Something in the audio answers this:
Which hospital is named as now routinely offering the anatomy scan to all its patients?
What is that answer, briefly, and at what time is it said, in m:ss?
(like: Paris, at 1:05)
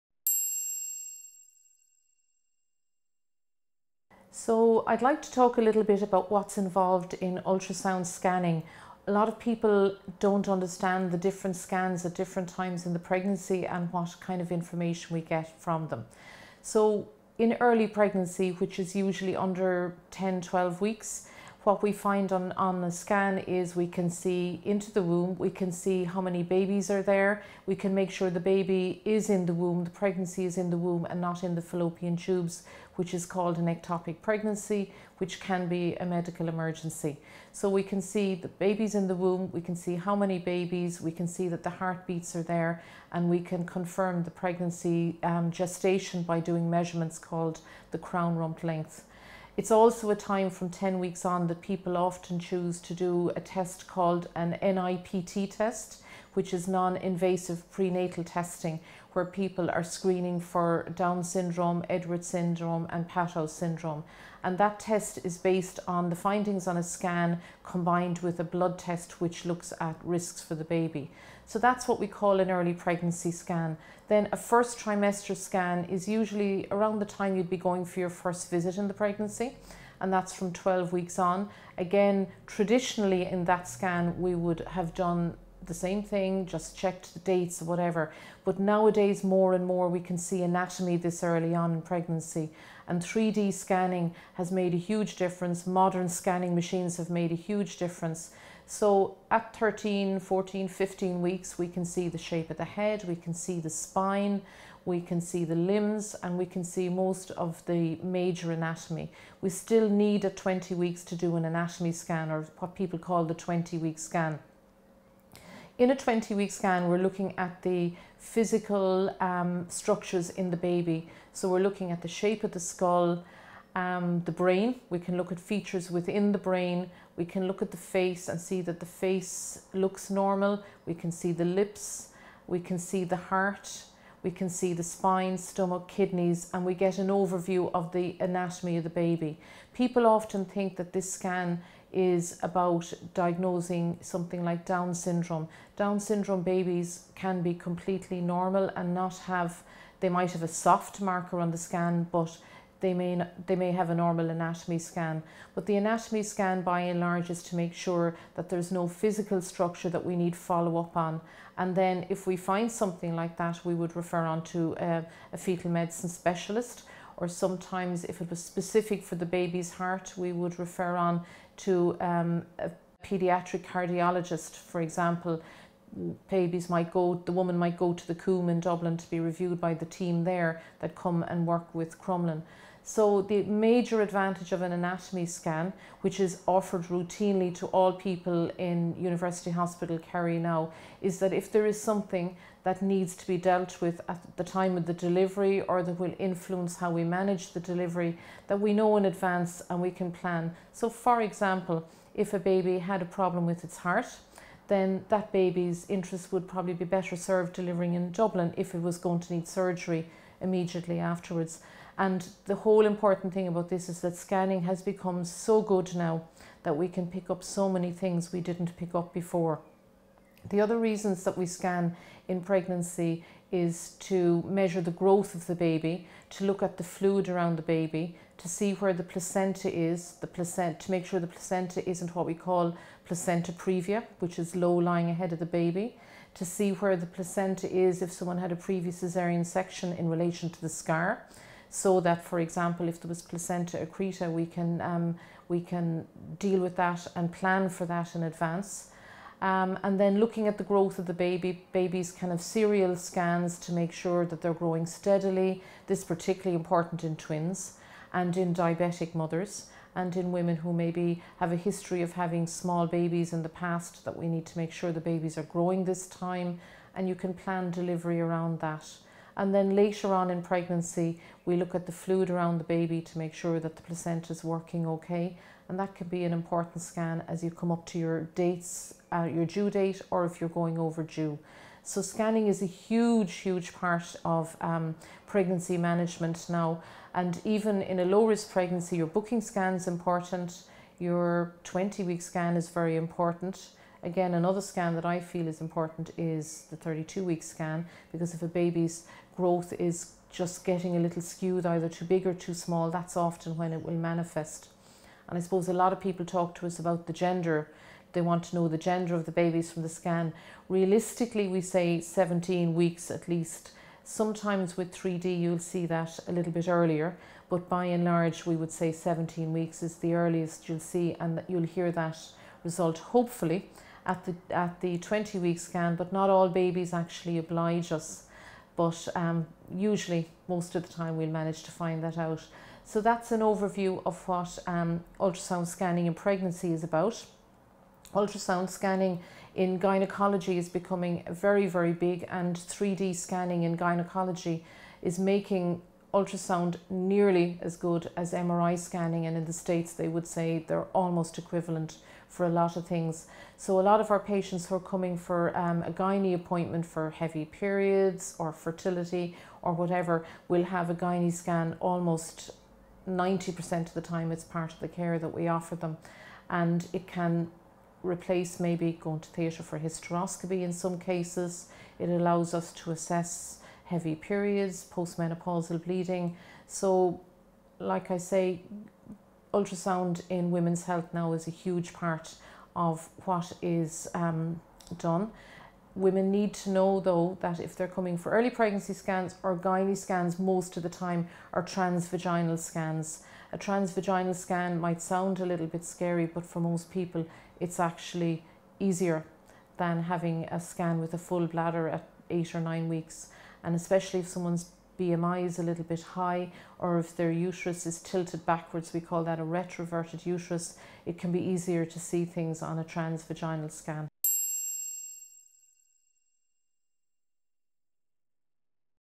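University Hospital Kerry, at 3:08.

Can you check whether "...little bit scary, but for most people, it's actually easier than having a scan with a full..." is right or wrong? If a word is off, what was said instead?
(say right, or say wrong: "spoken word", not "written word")
right.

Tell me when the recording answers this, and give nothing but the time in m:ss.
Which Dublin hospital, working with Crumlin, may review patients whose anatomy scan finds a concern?
2:58.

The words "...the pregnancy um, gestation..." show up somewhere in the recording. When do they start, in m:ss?
0:44.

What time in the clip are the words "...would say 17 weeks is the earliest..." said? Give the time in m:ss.
5:18.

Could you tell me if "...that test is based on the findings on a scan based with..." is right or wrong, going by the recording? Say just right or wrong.
wrong.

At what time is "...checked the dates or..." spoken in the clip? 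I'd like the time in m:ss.
1:26.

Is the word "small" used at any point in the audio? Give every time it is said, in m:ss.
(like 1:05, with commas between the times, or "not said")
4:22, 5:02.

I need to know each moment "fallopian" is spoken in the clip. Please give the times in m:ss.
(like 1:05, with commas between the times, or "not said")
0:31.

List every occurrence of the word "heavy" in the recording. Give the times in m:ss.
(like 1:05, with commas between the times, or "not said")
5:57, 6:13.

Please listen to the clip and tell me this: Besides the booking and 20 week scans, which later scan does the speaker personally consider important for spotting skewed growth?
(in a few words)
32 week scan.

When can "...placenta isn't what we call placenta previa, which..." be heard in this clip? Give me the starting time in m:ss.
3:51.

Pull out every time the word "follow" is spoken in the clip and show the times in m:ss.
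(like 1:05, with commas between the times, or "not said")
2:40.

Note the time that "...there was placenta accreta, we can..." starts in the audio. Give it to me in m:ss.
4:03.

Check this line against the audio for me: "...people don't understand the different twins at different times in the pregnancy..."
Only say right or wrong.
wrong.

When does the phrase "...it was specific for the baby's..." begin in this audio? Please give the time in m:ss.
2:48.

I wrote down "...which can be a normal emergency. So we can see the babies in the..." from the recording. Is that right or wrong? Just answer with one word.
wrong.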